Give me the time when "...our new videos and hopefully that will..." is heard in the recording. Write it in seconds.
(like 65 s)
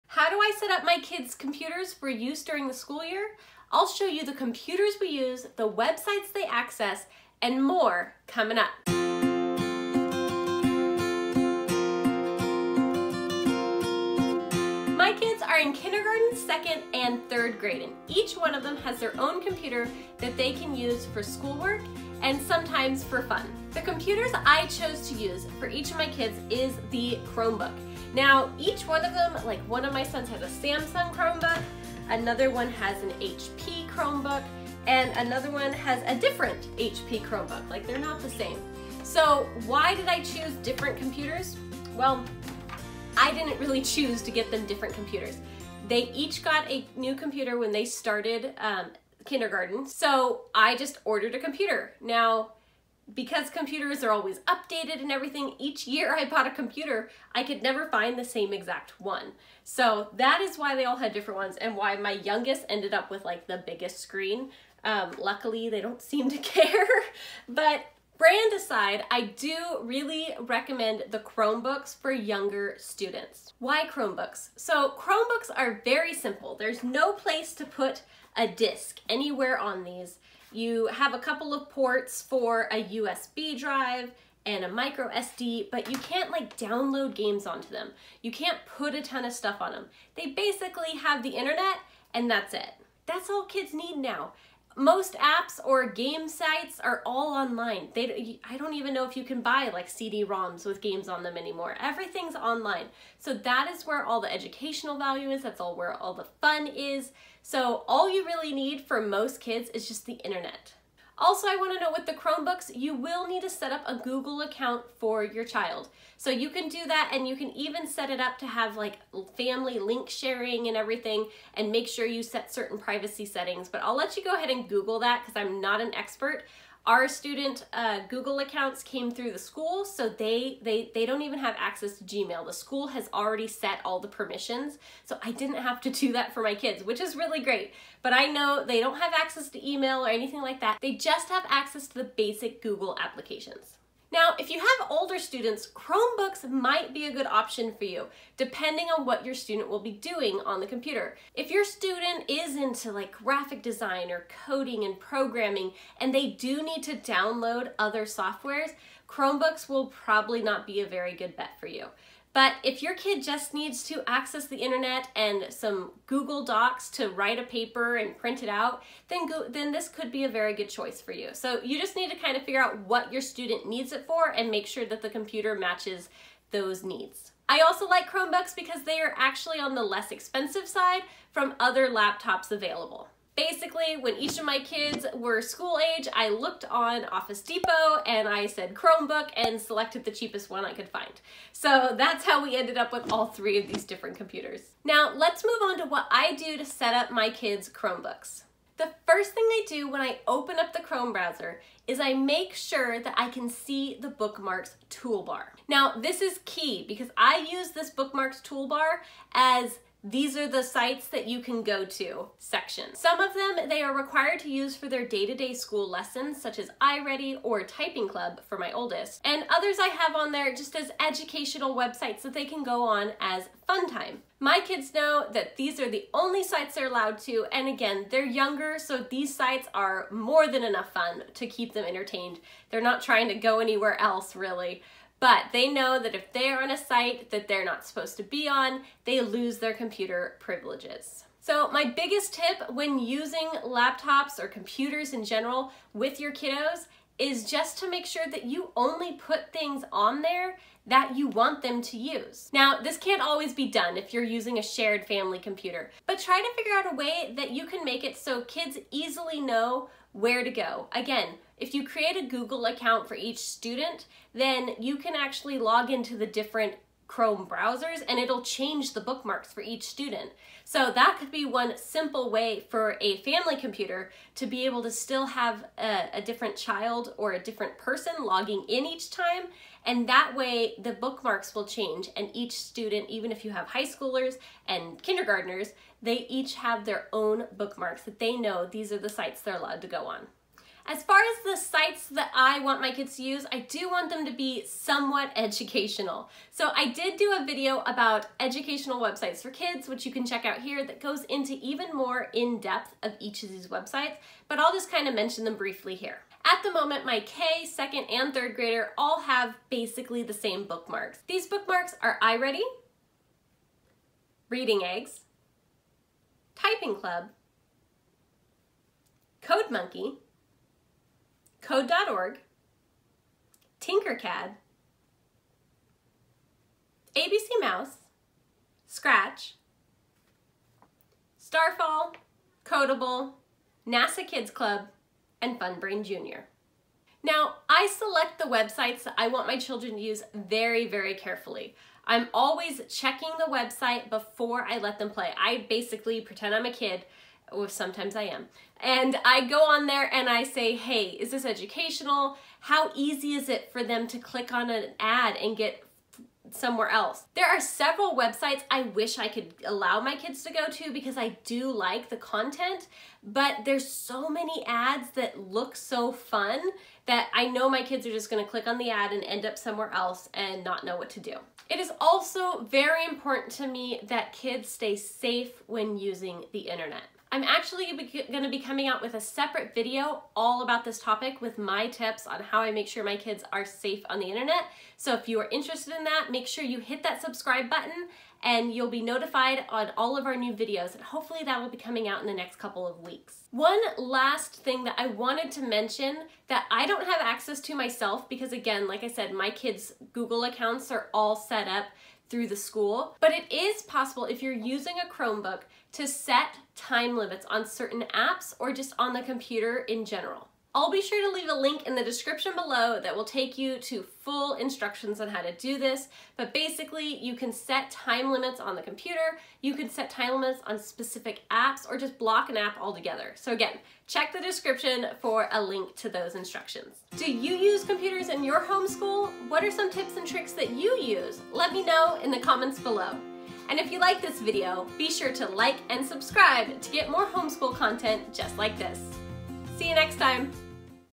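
390 s.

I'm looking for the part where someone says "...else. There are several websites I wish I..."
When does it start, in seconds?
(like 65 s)
356 s.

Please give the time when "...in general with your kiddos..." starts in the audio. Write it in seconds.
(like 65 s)
245 s.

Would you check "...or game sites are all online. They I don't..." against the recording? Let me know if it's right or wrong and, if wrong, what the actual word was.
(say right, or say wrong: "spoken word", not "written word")
right.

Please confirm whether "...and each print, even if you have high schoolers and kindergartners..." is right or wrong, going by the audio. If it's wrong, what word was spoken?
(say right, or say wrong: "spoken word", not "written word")
wrong: "student", not "print".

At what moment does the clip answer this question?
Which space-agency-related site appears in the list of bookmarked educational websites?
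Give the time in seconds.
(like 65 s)
333 s.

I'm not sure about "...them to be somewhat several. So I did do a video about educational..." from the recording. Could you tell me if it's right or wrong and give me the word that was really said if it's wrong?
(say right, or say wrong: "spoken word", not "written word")
wrong: "educational", not "several".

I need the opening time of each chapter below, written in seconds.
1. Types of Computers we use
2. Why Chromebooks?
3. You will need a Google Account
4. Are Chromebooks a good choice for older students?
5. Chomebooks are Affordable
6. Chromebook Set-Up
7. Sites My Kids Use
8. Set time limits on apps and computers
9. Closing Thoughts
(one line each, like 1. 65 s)
1. 25 s
2. 73 s
3. 111 s
4. 144 s
5. 178 s
6. 194 s
7. 290 s
8. 394 s
9. 427 s.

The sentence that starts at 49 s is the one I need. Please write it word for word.
So I just ordered a computer.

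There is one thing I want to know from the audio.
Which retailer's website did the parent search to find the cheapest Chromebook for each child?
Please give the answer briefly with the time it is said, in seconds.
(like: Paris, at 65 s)
Office Depot, at 187 s.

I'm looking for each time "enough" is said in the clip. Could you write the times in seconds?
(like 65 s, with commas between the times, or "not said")
230 s.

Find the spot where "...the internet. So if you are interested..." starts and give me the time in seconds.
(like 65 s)
384 s.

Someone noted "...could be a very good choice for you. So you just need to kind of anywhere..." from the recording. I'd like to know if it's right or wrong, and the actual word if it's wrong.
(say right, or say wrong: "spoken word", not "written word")
wrong: "figure", not "anywhere".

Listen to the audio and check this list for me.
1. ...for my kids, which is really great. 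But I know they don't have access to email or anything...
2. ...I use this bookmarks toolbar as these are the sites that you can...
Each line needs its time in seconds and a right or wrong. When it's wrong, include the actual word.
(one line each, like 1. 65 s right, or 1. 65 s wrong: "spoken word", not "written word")
1. 136 s right
2. 207 s right.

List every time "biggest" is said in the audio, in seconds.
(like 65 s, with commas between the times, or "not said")
63 s, 241 s.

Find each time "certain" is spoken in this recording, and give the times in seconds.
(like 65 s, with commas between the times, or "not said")
122 s, 407 s.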